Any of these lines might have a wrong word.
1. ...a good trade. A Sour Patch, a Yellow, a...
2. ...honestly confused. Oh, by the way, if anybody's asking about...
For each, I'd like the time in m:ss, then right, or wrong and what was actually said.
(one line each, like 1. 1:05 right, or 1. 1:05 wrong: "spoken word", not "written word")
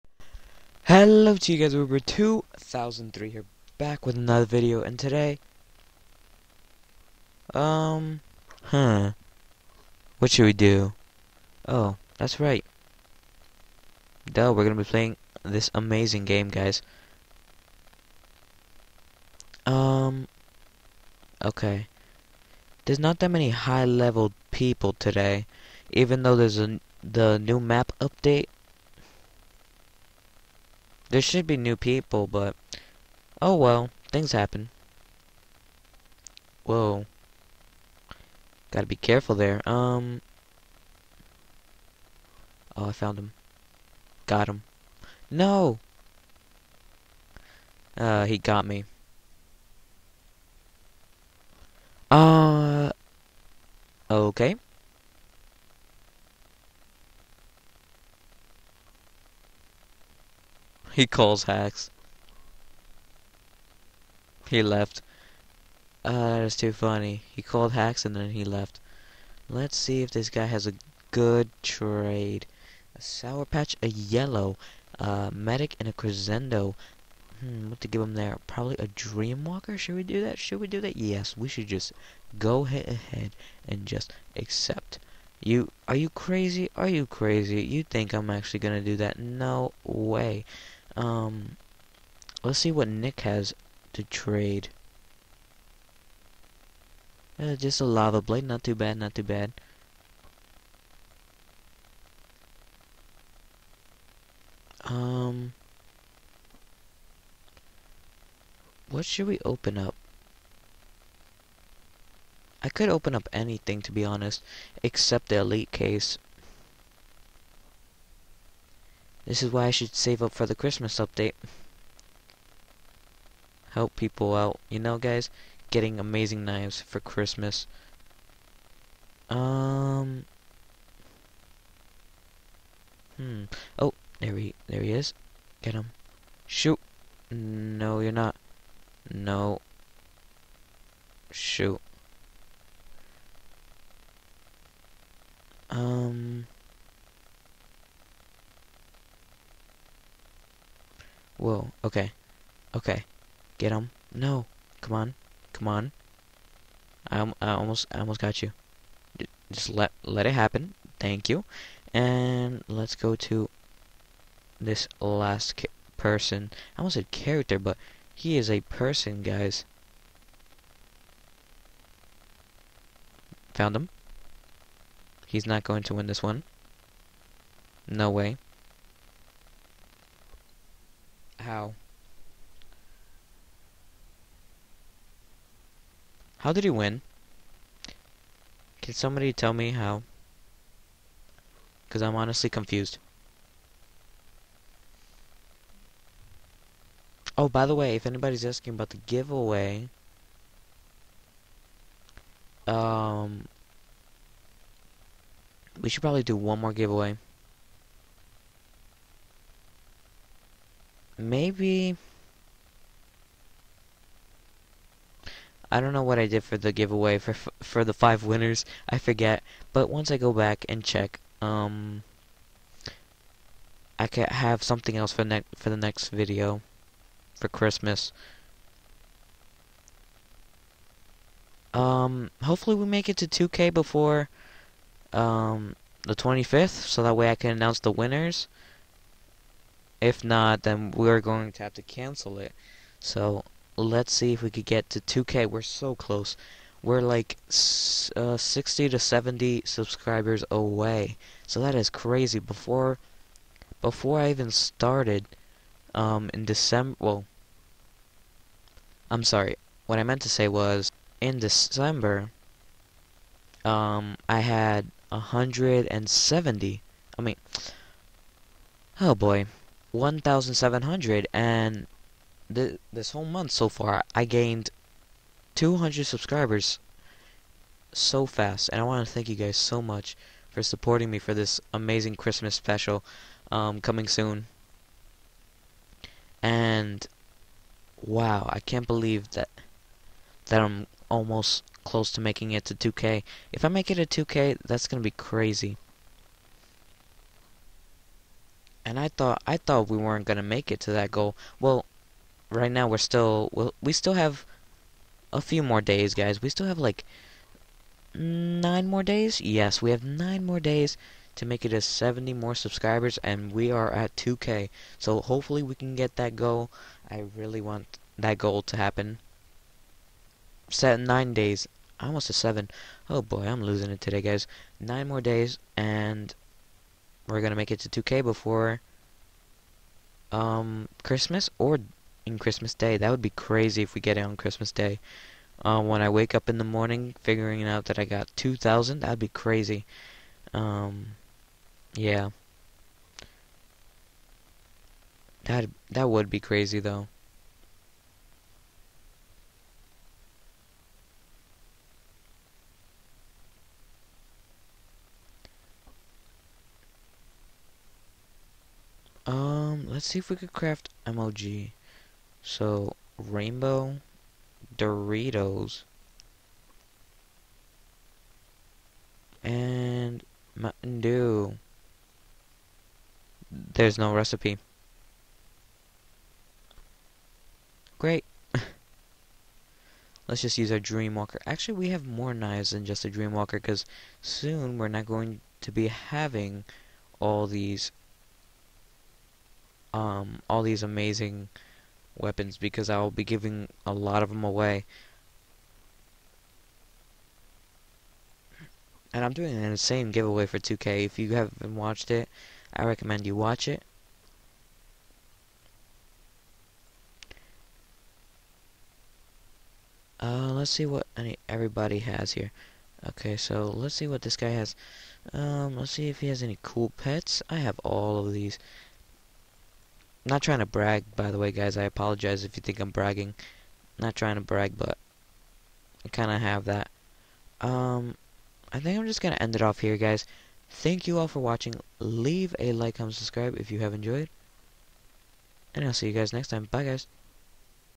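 1. 1:10 right
2. 3:12 right.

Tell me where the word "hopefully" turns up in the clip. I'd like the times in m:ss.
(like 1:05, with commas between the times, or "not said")
3:52, 5:15.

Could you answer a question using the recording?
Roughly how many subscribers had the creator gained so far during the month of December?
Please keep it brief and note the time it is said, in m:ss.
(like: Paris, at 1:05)
200, at 4:35.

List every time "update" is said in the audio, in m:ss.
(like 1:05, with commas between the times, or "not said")
0:28, 2:00.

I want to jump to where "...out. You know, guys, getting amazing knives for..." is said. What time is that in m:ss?
2:04.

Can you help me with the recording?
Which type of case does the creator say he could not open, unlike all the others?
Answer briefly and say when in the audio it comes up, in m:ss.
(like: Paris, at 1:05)
Elite case, at 1:55.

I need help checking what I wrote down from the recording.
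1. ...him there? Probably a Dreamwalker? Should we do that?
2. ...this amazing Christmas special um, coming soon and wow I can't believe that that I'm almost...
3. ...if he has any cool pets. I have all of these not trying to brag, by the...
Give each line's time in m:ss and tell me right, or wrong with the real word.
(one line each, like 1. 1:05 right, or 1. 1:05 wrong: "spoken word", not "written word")
1. 1:18 right
2. 4:41 right
3. 6:56 right.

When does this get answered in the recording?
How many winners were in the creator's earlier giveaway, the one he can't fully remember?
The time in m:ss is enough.
3:37.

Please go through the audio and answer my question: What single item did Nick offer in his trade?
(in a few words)
Lava blade.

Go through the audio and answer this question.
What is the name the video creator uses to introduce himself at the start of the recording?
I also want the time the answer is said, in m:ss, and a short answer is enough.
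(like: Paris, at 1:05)
Uber2003, at 0:01.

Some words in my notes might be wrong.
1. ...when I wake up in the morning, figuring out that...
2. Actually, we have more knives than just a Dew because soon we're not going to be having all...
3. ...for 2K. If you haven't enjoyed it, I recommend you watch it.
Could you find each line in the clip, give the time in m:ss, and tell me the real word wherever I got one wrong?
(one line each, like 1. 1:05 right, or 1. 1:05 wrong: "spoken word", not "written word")
1. 5:35 right
2. 6:21 wrong: "Dreamwalker", not "Dew"
3. 6:40 wrong: "watched", not "enjoyed".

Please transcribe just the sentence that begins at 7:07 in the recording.
Um, I think I'm just going to end it off here, guys.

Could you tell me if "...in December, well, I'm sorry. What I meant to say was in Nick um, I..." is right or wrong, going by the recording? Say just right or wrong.
wrong.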